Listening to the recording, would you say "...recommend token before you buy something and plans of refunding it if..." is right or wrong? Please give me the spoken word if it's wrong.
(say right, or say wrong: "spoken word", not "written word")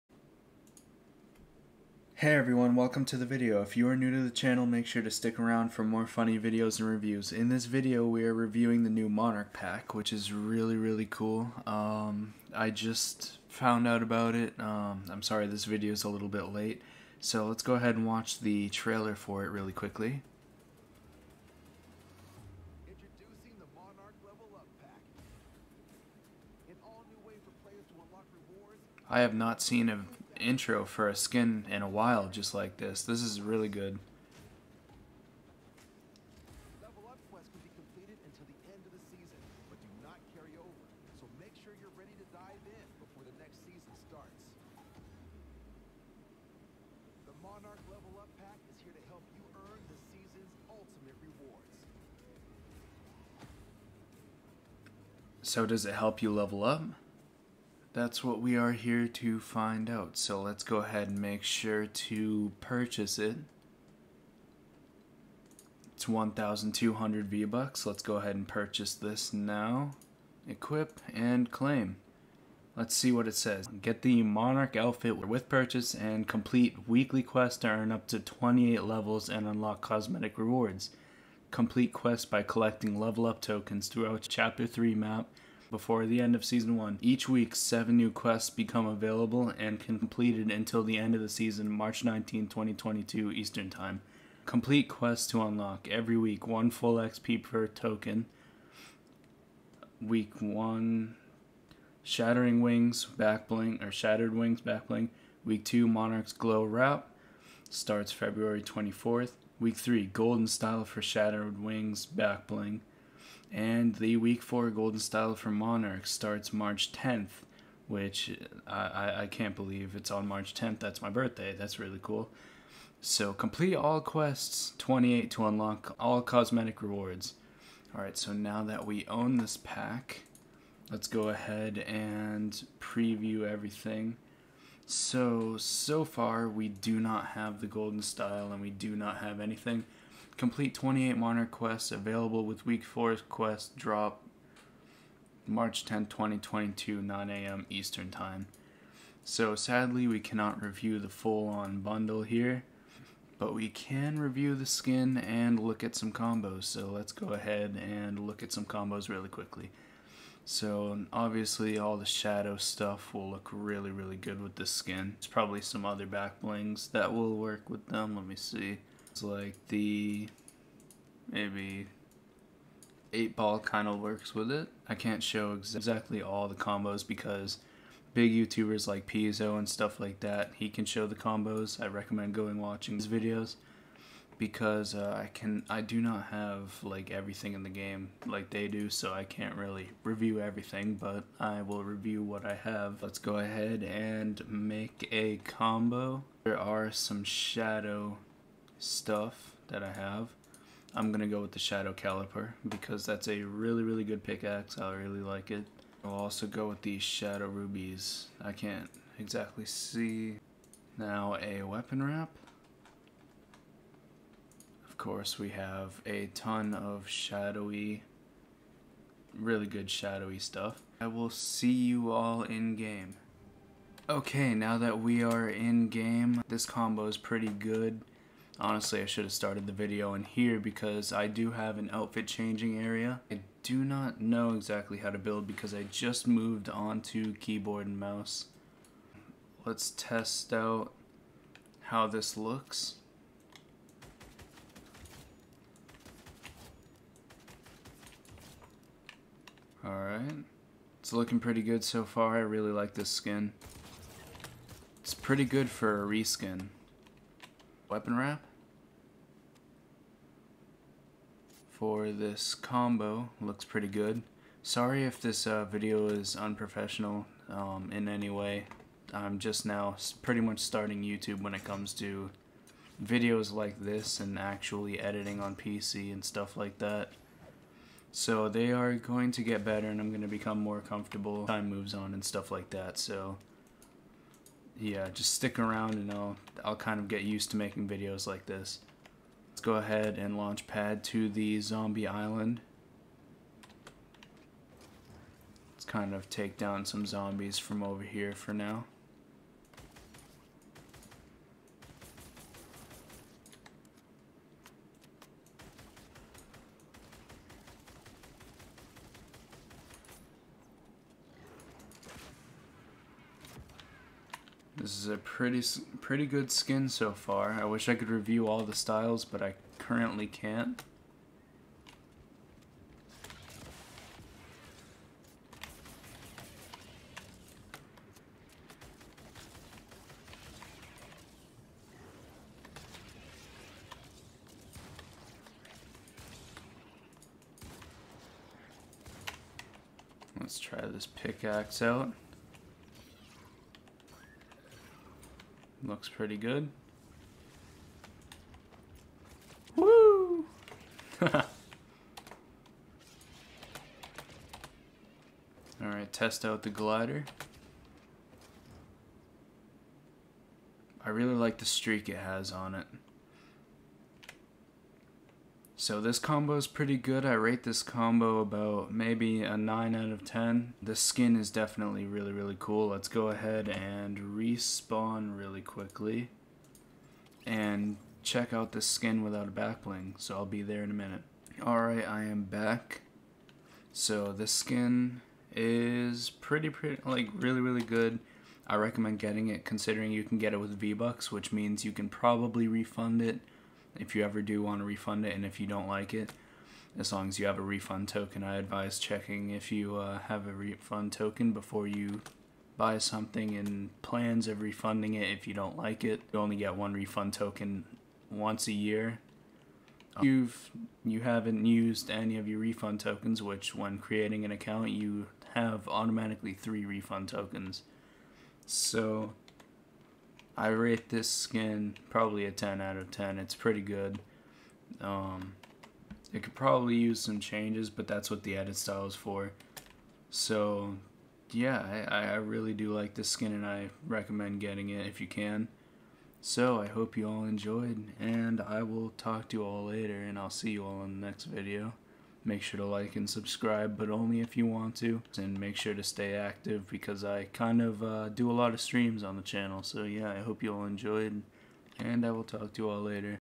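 wrong: "refund", not "recommend".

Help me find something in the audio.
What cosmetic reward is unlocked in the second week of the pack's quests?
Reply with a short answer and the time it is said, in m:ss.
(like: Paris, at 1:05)
Monarch's Glow Wrap, at 1:45.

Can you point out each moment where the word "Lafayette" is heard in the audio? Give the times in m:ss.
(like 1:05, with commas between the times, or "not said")
not said.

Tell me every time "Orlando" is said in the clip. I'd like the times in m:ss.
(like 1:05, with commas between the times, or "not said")
not said.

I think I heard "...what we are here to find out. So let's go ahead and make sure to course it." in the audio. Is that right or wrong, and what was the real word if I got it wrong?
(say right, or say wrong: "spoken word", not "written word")
wrong: "purchase", not "course".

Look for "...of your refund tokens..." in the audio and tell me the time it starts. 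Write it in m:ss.
6:52.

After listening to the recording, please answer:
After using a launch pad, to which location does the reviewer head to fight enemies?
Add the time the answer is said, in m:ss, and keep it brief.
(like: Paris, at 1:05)
zombie island, at 4:51.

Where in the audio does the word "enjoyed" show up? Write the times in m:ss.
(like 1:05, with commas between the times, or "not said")
7:17, 7:30.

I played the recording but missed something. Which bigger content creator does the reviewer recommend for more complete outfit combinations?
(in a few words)
Piezo.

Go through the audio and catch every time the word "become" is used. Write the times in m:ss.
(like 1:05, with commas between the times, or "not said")
1:28, 4:40.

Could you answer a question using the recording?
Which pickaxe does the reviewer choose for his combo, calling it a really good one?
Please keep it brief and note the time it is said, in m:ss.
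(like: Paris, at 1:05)
Shadow Caliper, at 3:21.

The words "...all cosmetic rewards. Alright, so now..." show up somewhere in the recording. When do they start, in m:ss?
2:05.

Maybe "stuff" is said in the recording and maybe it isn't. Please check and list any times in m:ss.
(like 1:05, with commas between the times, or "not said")
2:42, 2:59, 3:18, 3:40, 4:36, 4:42.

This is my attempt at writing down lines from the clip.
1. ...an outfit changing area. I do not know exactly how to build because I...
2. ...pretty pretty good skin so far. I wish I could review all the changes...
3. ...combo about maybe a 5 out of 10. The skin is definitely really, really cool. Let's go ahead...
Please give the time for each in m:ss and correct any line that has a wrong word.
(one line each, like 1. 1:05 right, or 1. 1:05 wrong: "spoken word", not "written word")
1. 3:51 right
2. 5:15 wrong: "styles", not "changes"
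3. 6:07 wrong: "9", not "5".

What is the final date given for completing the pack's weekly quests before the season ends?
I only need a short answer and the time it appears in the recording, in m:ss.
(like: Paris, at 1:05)
March 19, 2022, at 1:31.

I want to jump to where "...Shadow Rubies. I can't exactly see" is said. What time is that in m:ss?
3:26.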